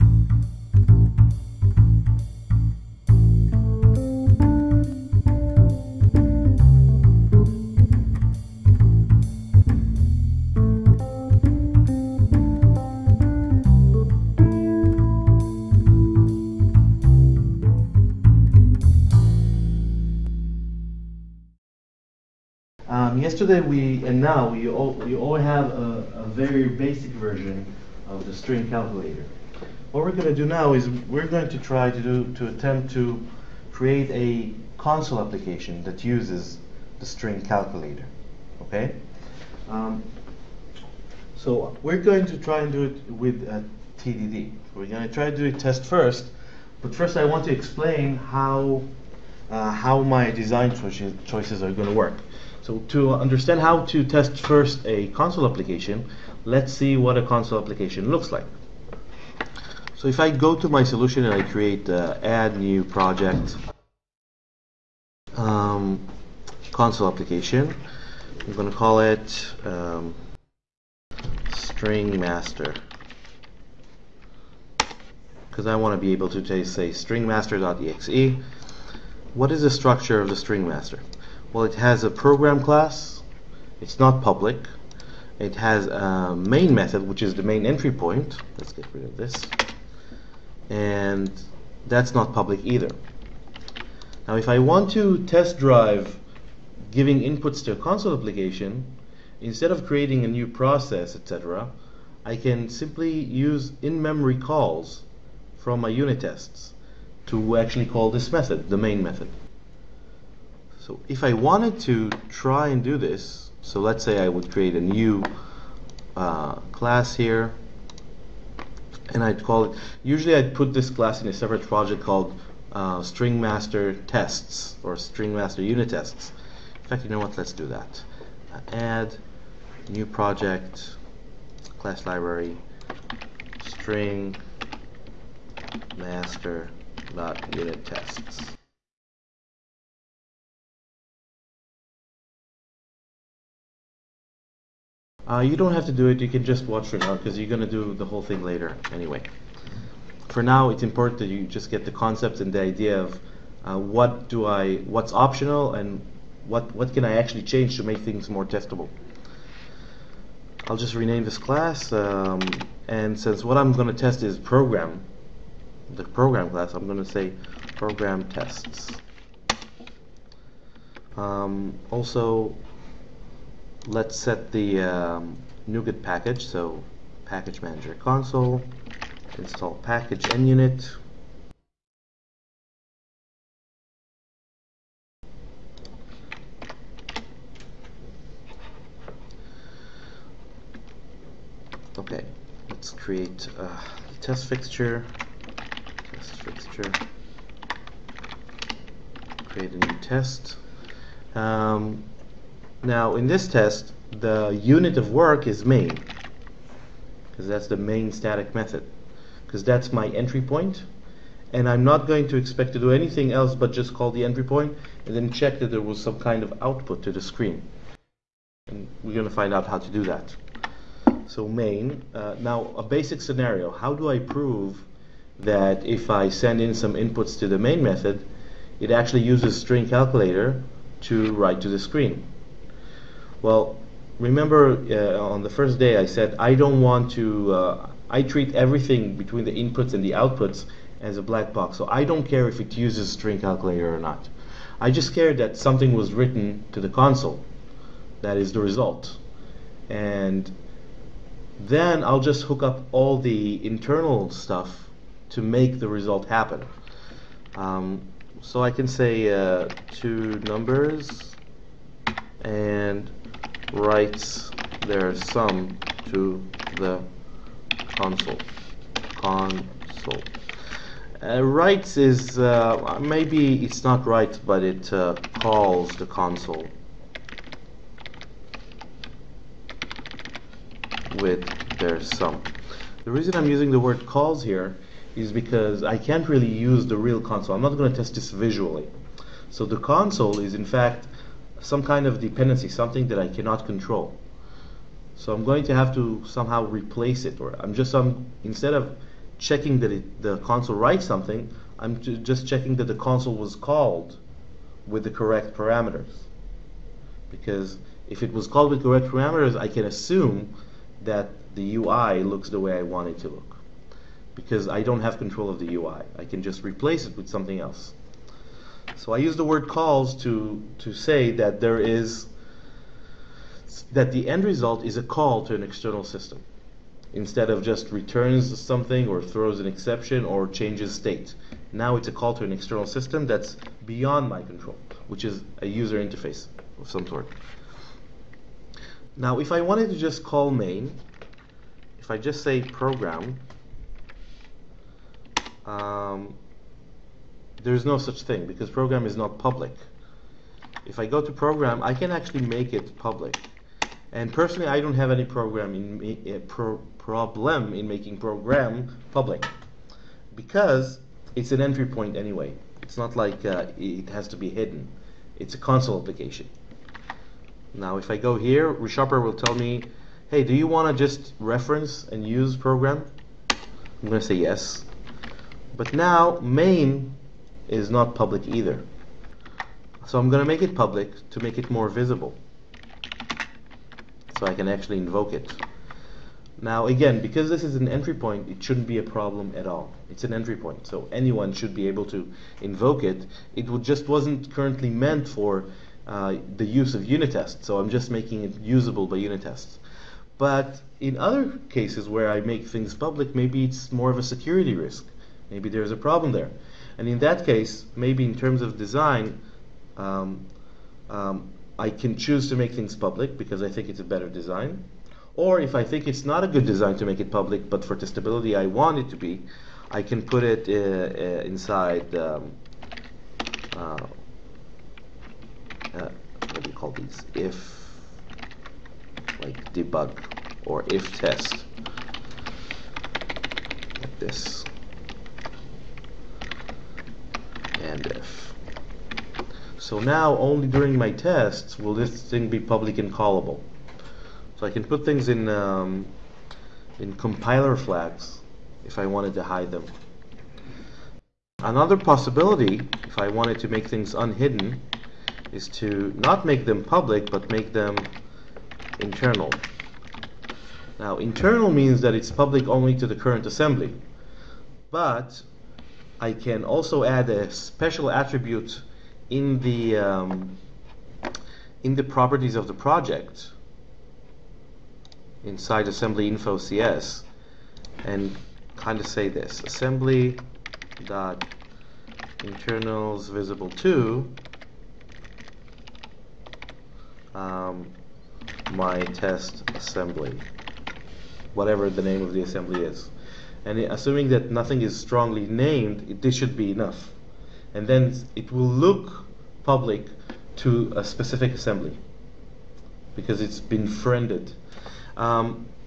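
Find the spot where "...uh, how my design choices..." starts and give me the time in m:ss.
0:49.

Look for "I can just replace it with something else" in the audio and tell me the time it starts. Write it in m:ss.
5:16.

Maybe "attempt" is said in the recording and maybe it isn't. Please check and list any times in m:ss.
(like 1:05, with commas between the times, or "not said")
0:32.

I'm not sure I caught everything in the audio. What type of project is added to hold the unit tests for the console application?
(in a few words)
class library.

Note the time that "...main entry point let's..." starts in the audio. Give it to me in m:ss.
1:27.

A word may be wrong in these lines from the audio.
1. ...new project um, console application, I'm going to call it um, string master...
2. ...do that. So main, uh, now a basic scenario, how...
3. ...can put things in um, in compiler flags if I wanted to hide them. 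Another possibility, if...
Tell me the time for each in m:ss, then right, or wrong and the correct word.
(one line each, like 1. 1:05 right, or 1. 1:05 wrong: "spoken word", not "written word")
1. 1:02 right
2. 3:39 right
3. 7:24 right.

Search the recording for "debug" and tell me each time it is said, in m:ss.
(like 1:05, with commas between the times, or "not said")
7:09.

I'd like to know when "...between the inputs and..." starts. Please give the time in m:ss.
3:59.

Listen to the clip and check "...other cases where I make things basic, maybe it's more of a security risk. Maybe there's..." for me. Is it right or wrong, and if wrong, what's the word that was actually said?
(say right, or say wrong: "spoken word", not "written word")
wrong: "public", not "basic".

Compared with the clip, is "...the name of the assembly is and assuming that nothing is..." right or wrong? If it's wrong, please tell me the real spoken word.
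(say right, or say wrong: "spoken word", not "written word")
right.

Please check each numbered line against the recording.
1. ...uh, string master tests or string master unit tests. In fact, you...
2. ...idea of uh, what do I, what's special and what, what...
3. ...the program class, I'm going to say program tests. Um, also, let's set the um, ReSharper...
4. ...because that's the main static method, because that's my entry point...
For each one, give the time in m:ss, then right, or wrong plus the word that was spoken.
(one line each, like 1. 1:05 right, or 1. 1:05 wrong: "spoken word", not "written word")
1. 2:02 right
2. 2:32 wrong: "optional", not "special"
3. 2:45 wrong: "NuGet", not "ReSharper"
4. 3:27 right.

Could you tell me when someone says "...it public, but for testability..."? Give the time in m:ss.
6:57.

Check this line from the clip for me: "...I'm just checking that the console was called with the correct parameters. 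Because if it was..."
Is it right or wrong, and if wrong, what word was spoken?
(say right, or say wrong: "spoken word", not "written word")
right.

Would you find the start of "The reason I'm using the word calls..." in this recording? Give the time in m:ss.
4:43.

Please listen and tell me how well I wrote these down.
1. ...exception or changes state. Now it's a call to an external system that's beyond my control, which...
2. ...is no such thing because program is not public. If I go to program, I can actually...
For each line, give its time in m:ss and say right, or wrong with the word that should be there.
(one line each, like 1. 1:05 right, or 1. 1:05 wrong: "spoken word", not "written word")
1. 5:29 right
2. 5:47 right.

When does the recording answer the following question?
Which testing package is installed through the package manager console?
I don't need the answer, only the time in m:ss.
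3:00.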